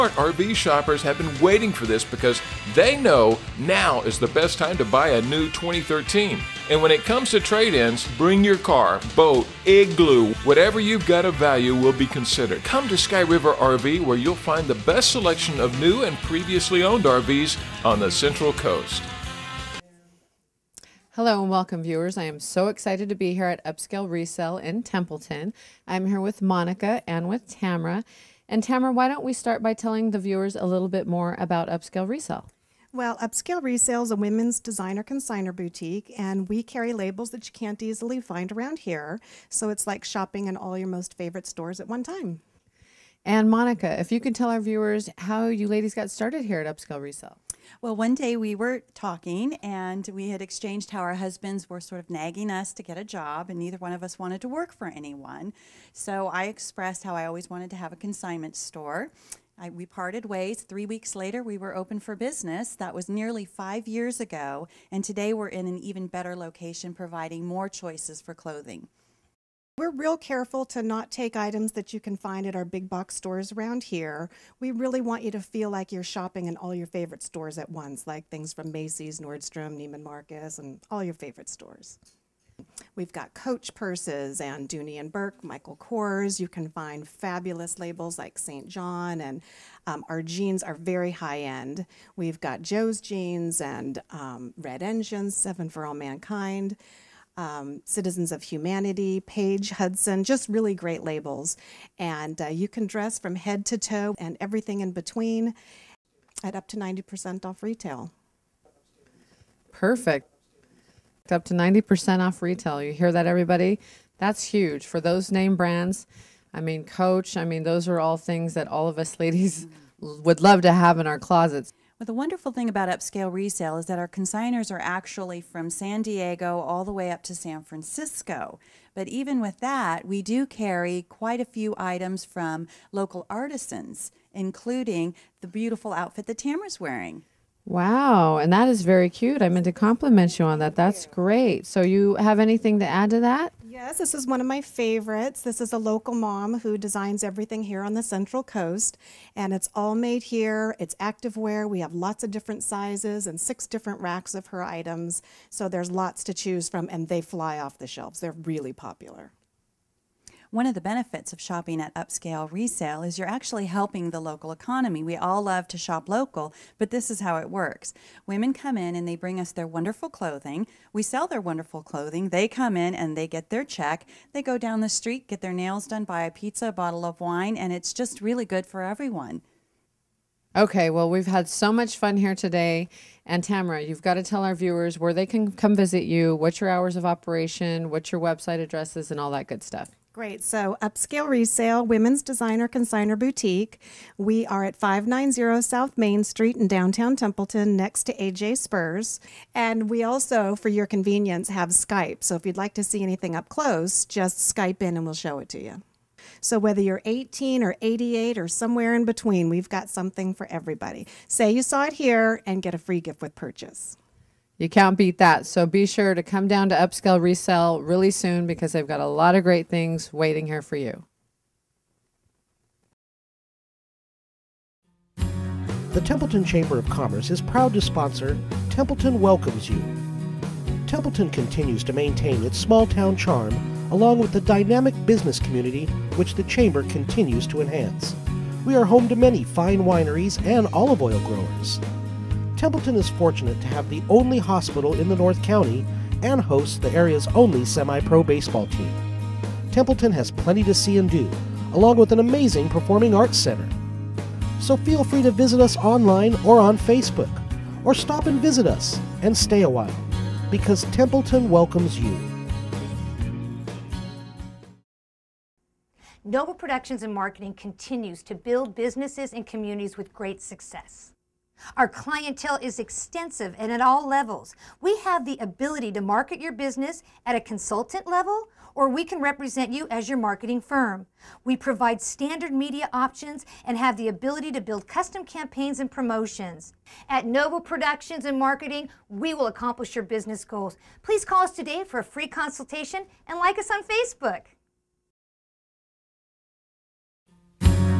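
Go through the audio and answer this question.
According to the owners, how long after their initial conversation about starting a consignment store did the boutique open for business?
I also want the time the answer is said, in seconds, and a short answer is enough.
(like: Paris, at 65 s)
3 weeks, at 60 s.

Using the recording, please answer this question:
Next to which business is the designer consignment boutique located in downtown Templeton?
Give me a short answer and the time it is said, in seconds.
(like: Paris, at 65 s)
AJ Spurs, at 198 s.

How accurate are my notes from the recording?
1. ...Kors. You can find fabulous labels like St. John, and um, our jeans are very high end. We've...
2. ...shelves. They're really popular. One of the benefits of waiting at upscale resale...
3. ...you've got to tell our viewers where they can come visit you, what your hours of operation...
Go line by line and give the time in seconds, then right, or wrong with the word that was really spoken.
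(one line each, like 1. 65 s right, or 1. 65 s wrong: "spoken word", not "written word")
1. 85 s right
2. 157 s wrong: "shopping", not "waiting"
3. 183 s right.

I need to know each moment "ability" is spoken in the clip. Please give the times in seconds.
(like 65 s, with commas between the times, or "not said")
275 s, 284 s.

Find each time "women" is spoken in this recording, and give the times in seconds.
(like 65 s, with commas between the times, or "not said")
34 s, 168 s, 191 s.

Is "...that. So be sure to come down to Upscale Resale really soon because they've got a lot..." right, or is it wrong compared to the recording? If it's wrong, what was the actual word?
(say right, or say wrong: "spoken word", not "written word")
right.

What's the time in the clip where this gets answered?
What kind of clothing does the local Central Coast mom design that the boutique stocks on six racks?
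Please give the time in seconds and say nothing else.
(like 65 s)
150 s.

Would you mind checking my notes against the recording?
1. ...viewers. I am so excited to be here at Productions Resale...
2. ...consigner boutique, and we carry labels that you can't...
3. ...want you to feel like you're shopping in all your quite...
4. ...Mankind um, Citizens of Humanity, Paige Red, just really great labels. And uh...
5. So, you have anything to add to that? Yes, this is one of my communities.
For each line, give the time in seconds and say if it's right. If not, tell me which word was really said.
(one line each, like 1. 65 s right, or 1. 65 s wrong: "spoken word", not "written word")
1. 21 s wrong: "Upscale", not "Productions"
2. 35 s right
3. 75 s wrong: "favorite", not "quite"
4. 95 s wrong: "Hudson", not "Red"
5. 141 s wrong: "favorites", not "communities".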